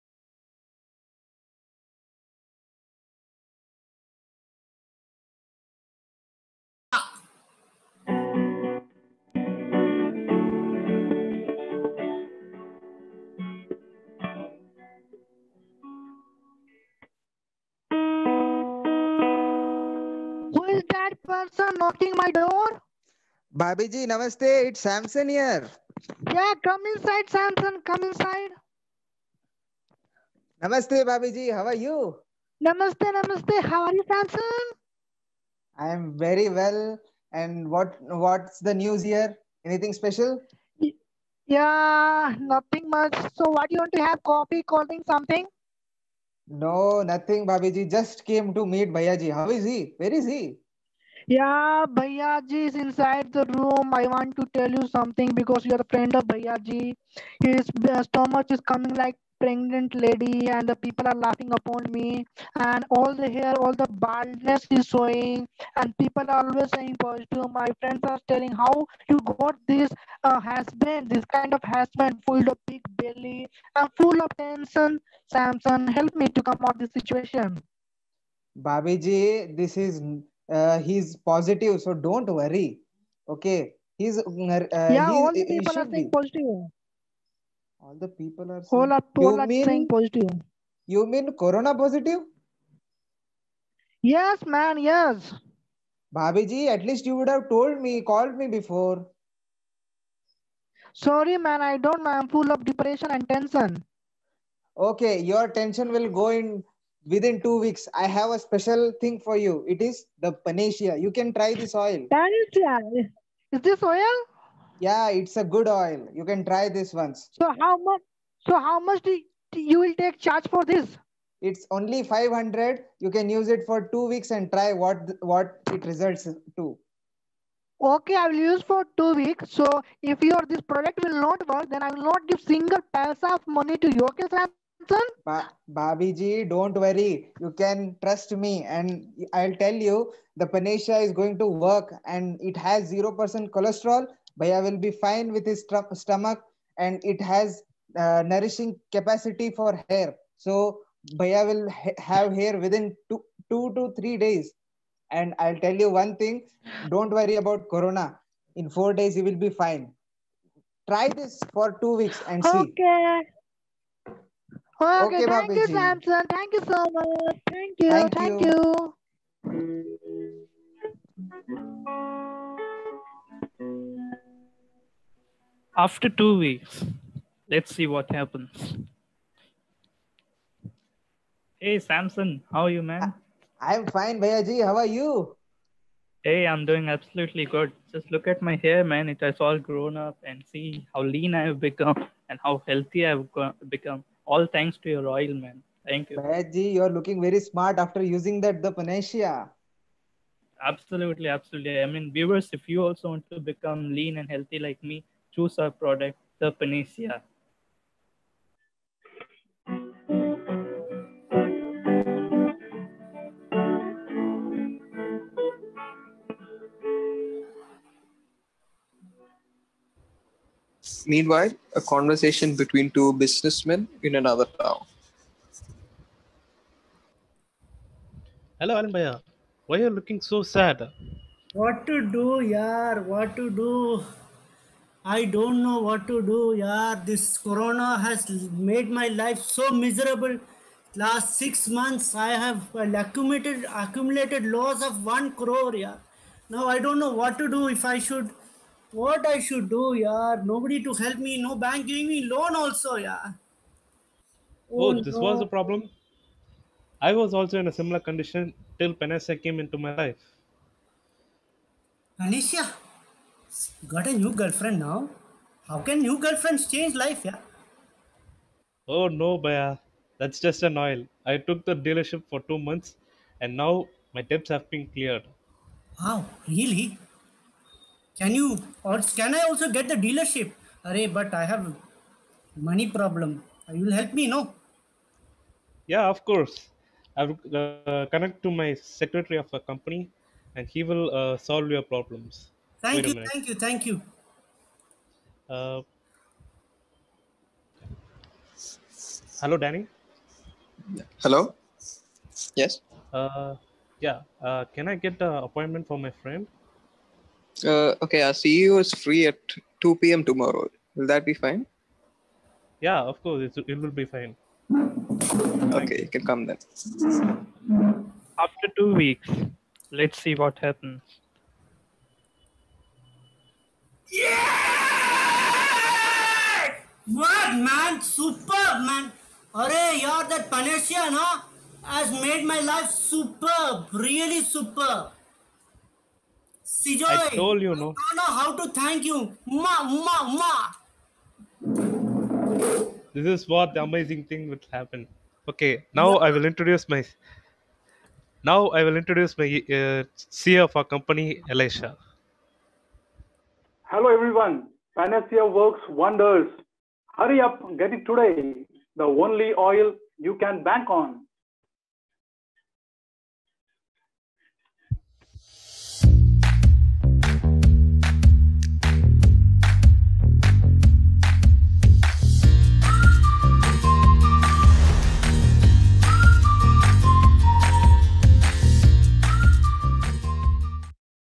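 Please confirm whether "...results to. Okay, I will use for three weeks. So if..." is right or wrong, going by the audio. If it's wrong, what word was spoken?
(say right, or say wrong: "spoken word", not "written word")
wrong: "two", not "three".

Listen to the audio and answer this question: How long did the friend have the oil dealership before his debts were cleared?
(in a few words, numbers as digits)
Two months.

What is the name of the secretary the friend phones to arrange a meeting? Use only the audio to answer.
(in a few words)
Danny.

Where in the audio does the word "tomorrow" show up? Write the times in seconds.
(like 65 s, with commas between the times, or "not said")
310 s.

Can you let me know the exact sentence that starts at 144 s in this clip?
Bhaiya will be fine with his tr- stomach and it has uh, nourishing capacity for hair.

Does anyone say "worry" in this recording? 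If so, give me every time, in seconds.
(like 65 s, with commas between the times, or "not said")
82 s, 136 s, 157 s.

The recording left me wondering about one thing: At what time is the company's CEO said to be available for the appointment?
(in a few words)
2 p.m.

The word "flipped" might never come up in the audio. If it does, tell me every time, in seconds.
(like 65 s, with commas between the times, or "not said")
not said.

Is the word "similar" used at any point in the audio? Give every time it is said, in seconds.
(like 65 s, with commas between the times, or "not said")
257 s.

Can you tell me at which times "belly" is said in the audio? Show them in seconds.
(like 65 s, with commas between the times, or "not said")
72 s.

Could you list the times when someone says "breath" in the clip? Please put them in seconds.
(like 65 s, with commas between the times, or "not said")
not said.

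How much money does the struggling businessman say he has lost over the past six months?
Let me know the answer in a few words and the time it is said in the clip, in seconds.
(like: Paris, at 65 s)
One crore, at 245 s.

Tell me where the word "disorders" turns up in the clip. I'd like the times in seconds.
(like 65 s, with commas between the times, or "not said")
not said.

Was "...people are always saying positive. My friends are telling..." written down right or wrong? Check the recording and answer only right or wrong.
right.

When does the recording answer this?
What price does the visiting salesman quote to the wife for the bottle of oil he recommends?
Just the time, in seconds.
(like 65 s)
121 s.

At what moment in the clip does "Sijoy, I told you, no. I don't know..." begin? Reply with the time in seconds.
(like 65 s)
336 s.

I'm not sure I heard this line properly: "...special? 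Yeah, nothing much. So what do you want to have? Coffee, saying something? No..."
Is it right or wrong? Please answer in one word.
wrong.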